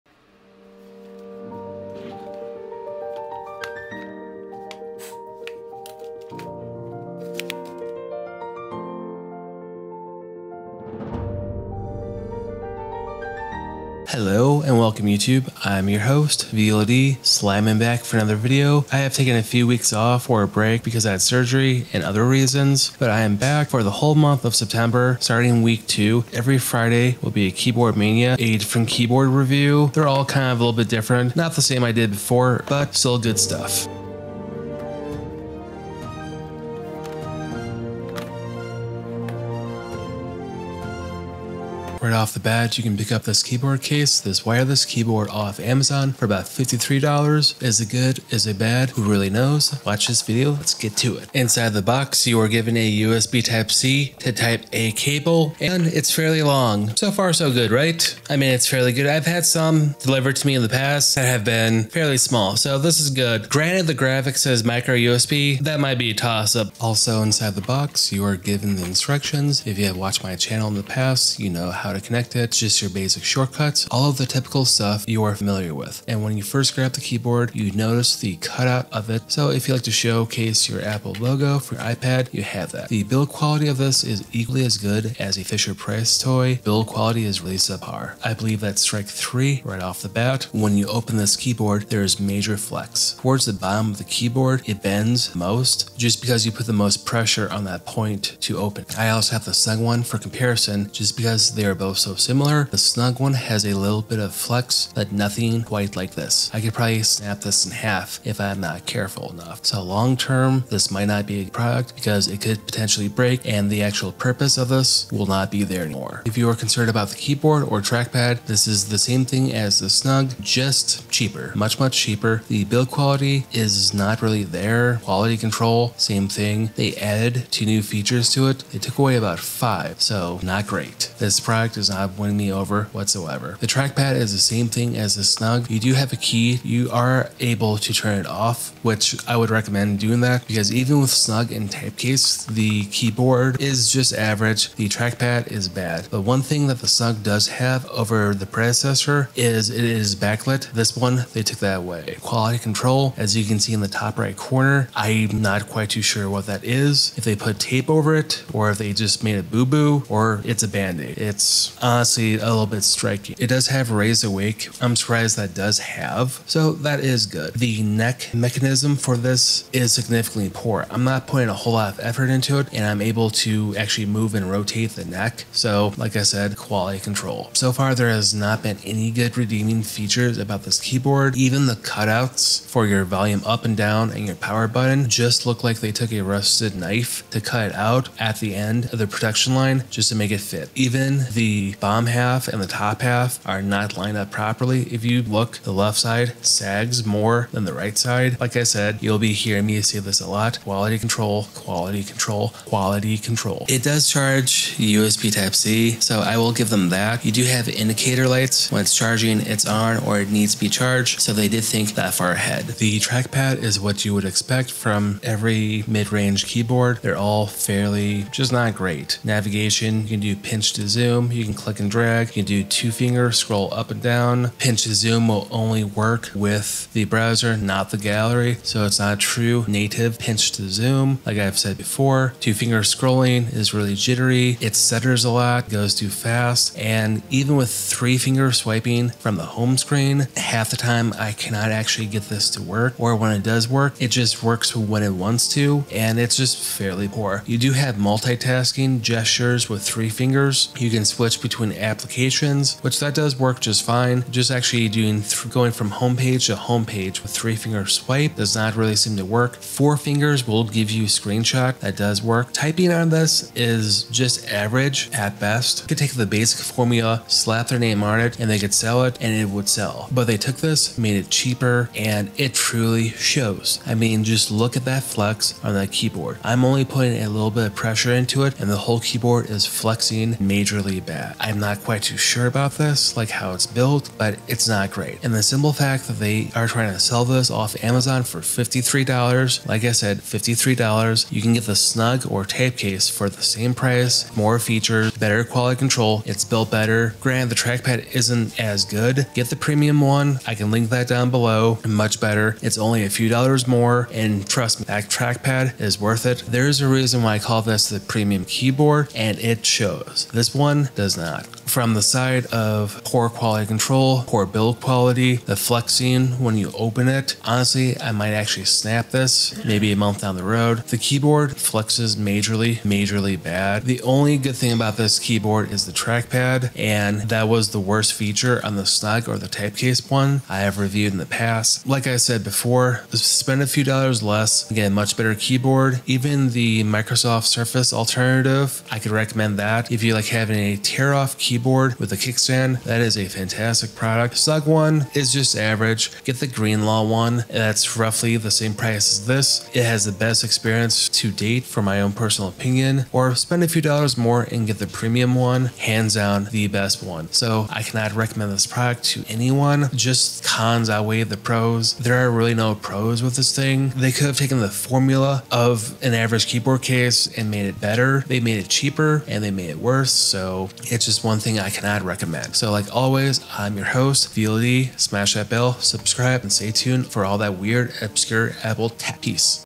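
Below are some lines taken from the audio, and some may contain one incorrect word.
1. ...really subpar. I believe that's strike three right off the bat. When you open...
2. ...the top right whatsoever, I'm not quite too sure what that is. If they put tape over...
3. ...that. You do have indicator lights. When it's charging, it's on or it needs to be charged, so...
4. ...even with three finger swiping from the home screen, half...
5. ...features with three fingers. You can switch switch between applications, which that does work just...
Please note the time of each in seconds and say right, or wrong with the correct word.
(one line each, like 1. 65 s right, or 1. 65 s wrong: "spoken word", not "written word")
1. 87 s right
2. 153 s wrong: "corner", not "whatsoever"
3. 206 s right
4. 237 s right
5. 249 s wrong: "gestures", not "features".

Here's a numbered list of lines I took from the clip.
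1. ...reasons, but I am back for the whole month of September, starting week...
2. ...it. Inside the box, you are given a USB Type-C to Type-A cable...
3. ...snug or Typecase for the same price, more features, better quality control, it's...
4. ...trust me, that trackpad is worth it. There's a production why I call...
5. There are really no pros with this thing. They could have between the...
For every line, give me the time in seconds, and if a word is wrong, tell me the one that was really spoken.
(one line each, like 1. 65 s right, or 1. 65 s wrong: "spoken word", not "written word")
1. 22 s right
2. 51 s right
3. 291 s right
4. 304 s wrong: "reason", not "production"
5. 361 s wrong: "taken", not "between".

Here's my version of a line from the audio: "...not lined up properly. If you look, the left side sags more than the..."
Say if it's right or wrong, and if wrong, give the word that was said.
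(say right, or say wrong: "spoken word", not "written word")
right.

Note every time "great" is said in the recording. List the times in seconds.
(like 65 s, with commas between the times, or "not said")
130 s, 218 s, 284 s.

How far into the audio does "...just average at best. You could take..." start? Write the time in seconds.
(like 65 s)
264 s.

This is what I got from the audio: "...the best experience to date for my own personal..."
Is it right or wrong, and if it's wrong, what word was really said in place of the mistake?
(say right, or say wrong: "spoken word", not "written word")
right.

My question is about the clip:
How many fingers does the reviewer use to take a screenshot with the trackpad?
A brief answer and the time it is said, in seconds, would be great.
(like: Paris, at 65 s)
4, at 259 s.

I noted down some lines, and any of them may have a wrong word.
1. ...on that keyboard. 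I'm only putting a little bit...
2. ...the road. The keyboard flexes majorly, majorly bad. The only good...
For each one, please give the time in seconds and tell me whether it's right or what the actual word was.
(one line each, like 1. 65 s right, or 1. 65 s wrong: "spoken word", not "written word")
1. 275 s right
2. 320 s right.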